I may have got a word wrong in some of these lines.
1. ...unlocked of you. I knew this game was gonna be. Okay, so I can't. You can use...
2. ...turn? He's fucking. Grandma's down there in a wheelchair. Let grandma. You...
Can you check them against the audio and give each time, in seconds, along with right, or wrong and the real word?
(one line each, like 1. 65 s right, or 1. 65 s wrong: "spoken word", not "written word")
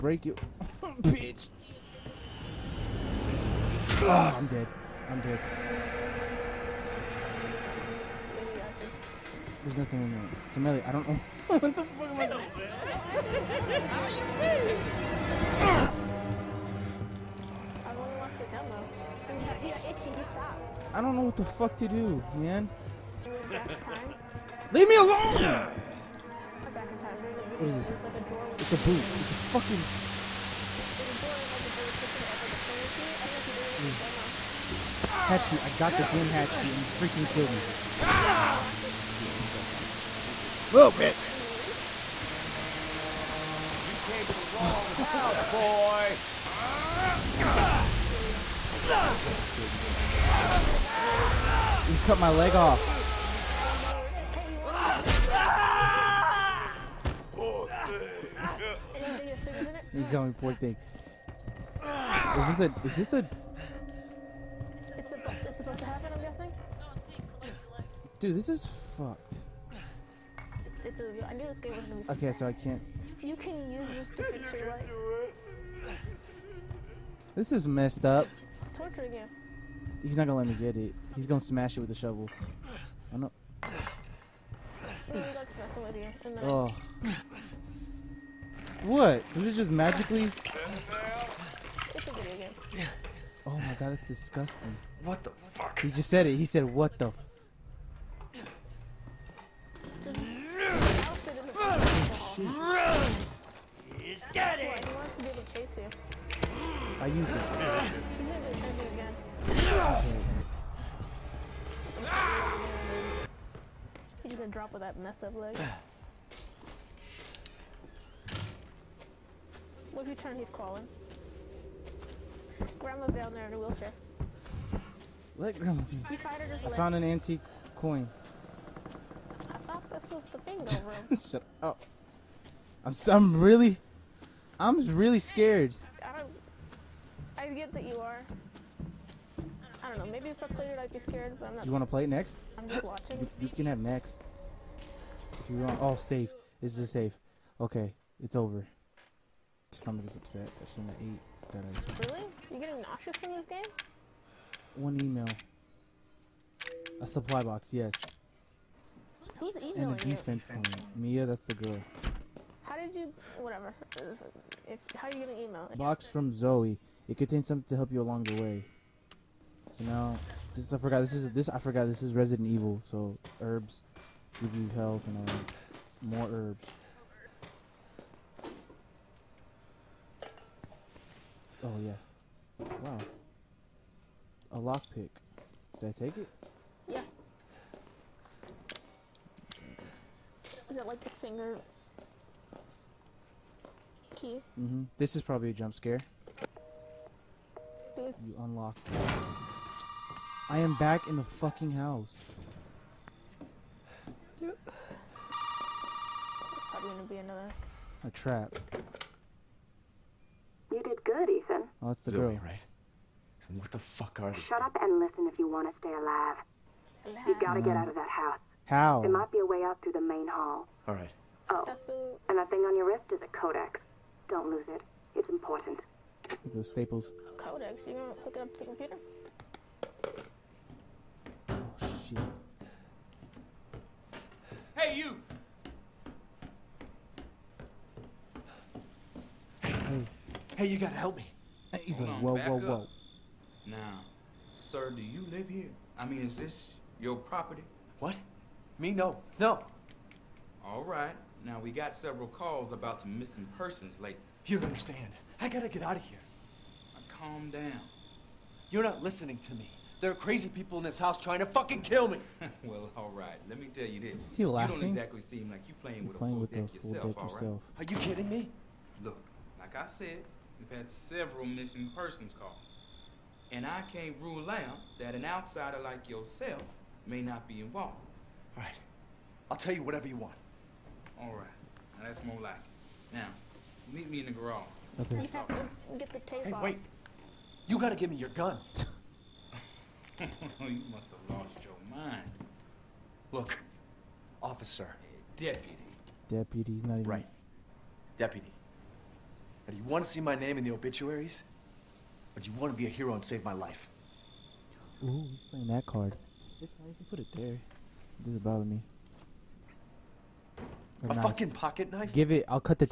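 1. 68 s wrong: "fucked", not "unlocked"
2. 120 s wrong: "crawling", not "fucking".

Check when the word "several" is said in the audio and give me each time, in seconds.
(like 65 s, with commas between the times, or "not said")
251 s, 270 s.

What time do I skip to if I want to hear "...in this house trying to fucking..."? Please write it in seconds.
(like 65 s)
260 s.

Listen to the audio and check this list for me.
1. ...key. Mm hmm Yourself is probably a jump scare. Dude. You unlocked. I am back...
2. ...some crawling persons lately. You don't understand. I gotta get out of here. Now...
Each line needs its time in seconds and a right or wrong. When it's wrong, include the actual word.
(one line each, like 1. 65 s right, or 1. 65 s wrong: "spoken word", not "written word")
1. 194 s wrong: "This", not "Yourself"
2. 253 s wrong: "missing", not "crawling".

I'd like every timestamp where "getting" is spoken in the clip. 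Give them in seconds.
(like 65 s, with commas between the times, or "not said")
152 s.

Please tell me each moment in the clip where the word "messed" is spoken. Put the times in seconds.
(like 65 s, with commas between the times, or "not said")
77 s, 114 s.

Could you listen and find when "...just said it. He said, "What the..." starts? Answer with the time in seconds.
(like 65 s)
95 s.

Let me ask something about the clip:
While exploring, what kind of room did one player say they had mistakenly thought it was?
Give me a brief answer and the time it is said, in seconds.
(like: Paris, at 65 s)
Bingo room, at 130 s.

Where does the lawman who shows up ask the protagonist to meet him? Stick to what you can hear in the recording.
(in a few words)
The garage.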